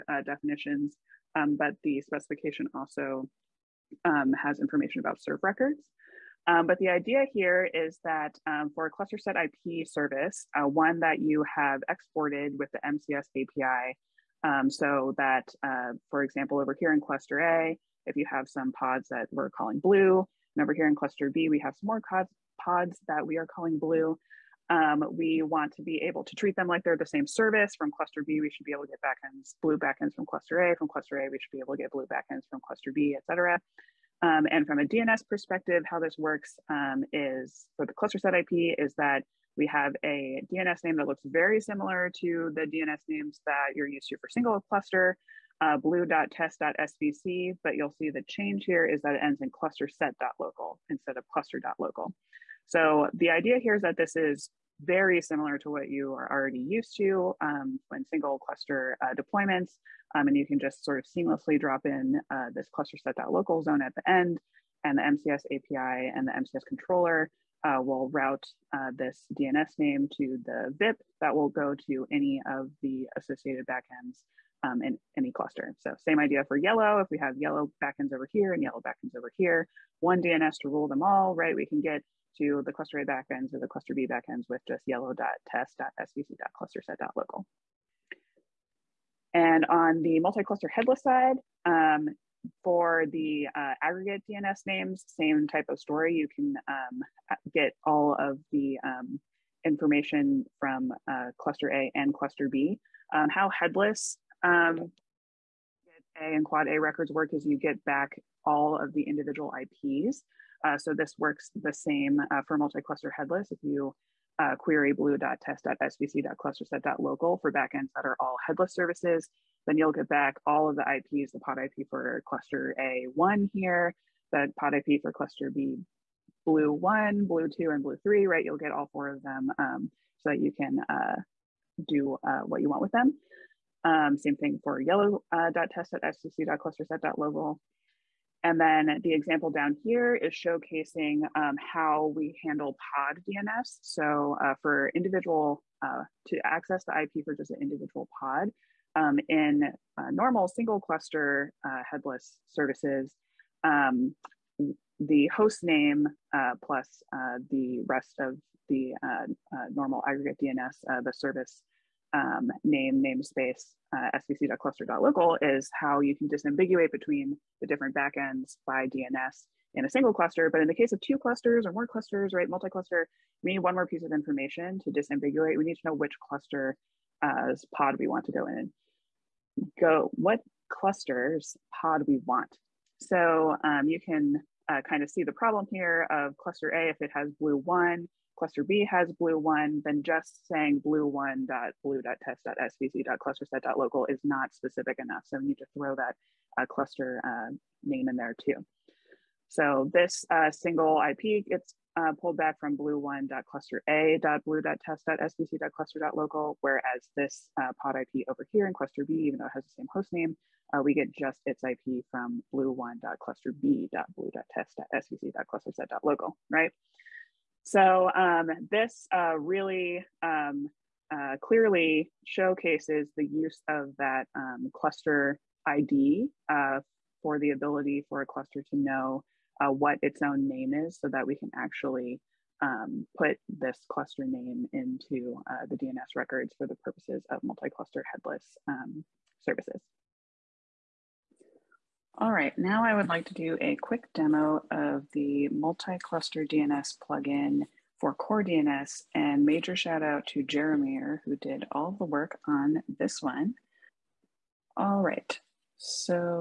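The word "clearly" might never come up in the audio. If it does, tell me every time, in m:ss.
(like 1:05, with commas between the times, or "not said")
3:41.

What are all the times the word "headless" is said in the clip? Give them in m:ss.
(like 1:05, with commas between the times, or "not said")
1:30, 1:43, 1:53, 1:58, 2:31, 3:58.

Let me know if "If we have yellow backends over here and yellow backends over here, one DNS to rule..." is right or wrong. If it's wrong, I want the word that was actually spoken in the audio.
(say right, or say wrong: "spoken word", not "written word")
right.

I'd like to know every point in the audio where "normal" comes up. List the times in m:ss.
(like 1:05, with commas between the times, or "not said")
2:30, 2:39.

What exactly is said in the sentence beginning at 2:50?
But in the case of two clusters or more clusters, right, multi-cluster, we need one more piece of information to disambiguate.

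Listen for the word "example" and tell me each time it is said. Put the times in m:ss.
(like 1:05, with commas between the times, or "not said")
0:16, 2:19.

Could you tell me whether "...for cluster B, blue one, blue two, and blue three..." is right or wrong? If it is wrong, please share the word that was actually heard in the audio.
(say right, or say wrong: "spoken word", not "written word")
right.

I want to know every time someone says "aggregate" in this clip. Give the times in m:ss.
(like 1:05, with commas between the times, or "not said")
1:33, 2:40.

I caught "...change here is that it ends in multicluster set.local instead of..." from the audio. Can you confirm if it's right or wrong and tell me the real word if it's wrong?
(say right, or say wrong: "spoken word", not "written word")
wrong: "cluster", not "multicluster".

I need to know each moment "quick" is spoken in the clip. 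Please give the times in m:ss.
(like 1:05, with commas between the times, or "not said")
4:03.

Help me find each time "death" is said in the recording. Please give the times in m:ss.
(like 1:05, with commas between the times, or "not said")
not said.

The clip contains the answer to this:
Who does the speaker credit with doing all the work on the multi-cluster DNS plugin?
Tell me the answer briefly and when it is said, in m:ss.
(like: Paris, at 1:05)
Jeremy, at 4:10.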